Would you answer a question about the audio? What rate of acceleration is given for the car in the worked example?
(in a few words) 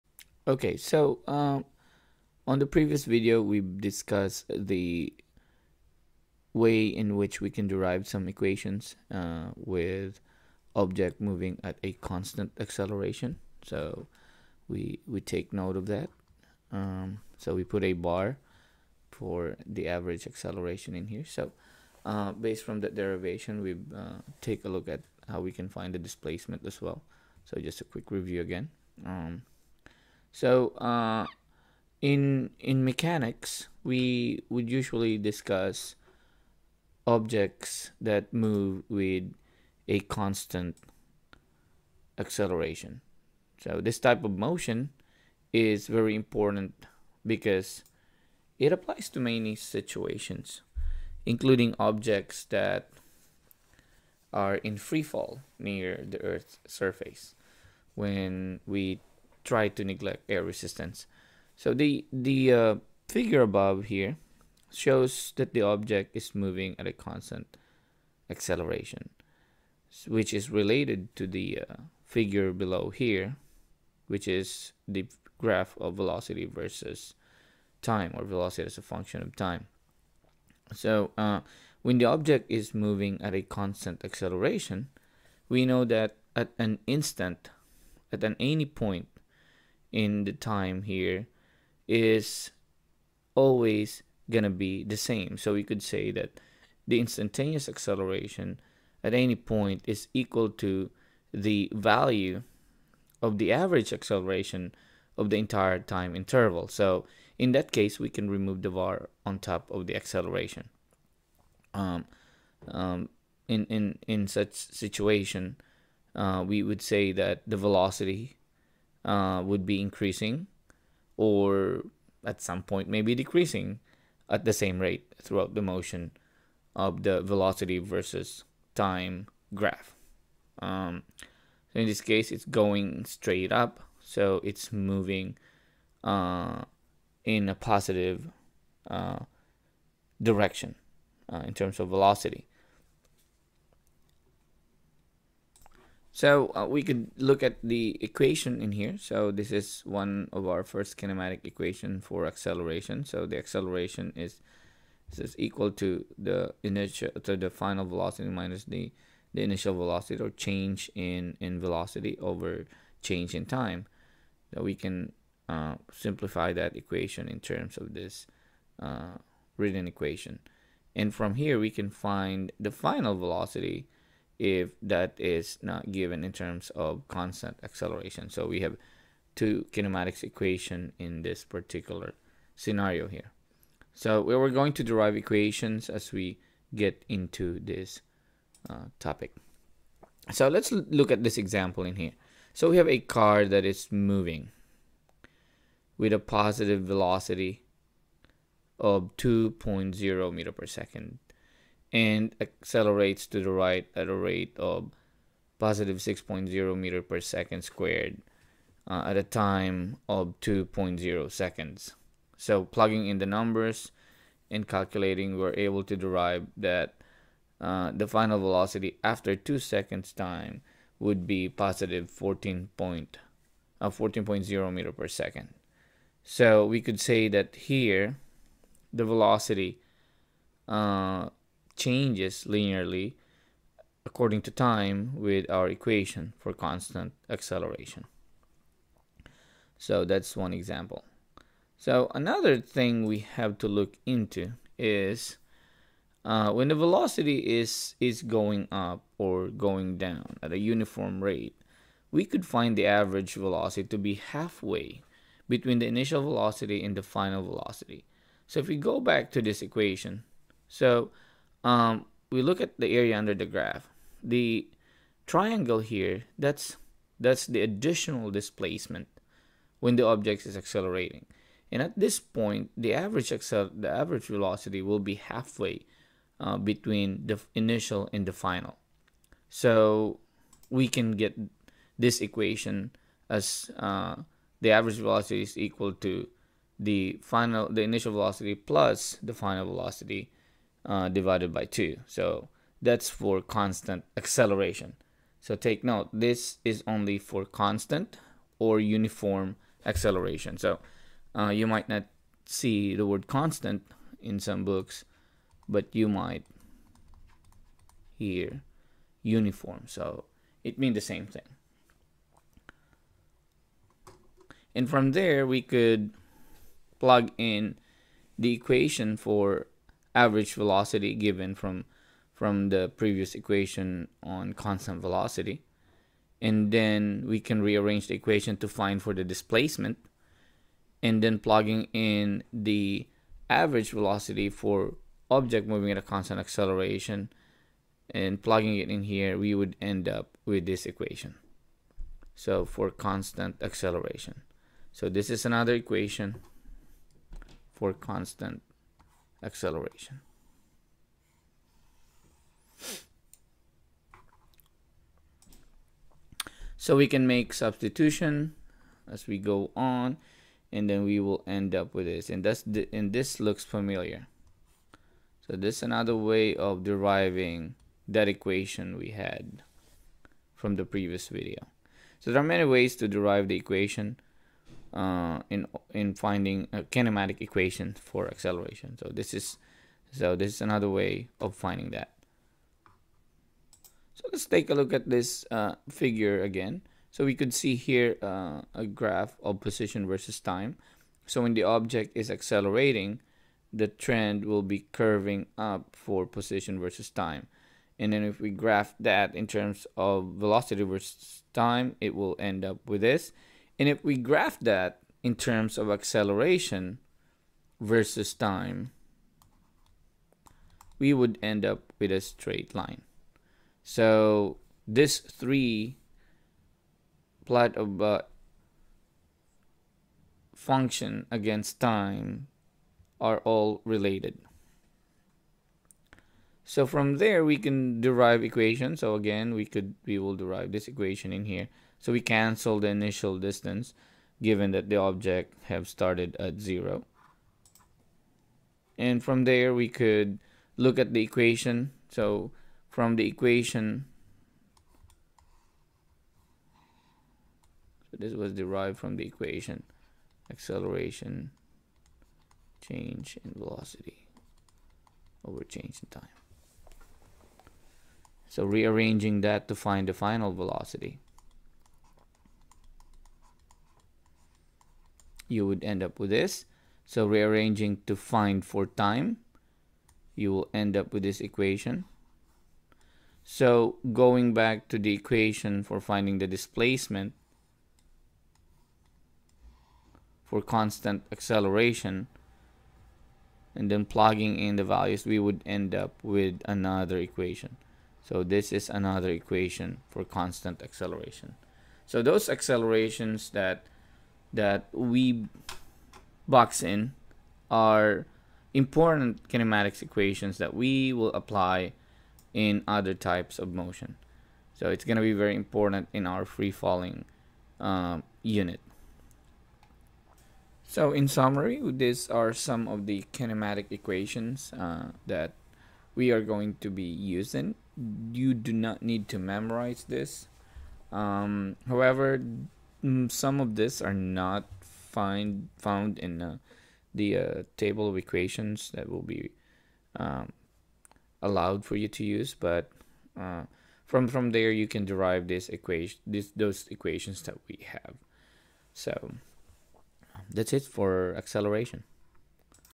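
6.0 m/s².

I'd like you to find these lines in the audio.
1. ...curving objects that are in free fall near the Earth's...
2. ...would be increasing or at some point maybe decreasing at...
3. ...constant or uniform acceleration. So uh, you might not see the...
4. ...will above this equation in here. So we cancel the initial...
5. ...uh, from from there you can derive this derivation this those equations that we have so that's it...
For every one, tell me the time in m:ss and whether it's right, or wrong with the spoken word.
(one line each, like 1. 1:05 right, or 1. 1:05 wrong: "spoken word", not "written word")
1. 0:51 wrong: "including", not "curving"
2. 1:59 right
3. 4:57 right
4. 7:10 wrong: "derive", not "above"
5. 8:53 wrong: "equation", not "derivation".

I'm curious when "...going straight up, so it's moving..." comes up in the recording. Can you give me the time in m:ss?
2:12.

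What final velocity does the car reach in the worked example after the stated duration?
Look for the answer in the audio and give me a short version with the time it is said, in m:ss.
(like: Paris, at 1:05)
14.0 m/s, at 3:43.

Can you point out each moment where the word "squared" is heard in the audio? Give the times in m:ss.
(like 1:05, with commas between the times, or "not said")
3:27.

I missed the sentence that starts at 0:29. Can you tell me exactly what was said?
Um, so uh, in in mechanics, we would usually discuss objects that move with a constant acceleration.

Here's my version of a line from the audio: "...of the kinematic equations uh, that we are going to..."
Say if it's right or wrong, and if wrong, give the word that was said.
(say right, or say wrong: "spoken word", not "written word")
right.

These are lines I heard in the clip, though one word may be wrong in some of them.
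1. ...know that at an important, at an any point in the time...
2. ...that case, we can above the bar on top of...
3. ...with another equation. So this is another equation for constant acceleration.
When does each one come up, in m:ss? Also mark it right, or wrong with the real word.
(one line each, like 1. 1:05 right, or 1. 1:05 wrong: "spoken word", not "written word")
1. 1:25 wrong: "instant", not "important"
2. 1:47 wrong: "remove", not "above"
3. 8:06 right.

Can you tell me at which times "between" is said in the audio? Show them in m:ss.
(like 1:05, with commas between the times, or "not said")
4:15, 4:36.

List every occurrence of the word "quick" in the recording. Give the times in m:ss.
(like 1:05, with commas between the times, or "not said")
0:27.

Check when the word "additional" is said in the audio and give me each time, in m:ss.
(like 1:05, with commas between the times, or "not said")
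4:27.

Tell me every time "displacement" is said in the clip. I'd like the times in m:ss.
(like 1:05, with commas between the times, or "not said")
0:26, 4:28, 5:29, 7:56.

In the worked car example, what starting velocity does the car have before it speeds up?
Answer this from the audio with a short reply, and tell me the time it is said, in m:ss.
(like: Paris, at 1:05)
2.0 m/s, at 3:19.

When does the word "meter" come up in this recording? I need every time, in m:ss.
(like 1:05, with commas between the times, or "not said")
3:20, 3:26, 3:44.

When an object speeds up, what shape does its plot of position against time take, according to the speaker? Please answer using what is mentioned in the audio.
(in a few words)
curving up.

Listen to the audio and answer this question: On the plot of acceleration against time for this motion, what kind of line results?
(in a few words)
a straight line.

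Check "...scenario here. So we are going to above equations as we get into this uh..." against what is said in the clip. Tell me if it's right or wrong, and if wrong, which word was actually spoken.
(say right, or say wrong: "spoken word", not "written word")
wrong: "derive", not "above".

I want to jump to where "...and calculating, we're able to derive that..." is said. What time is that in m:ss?
3:34.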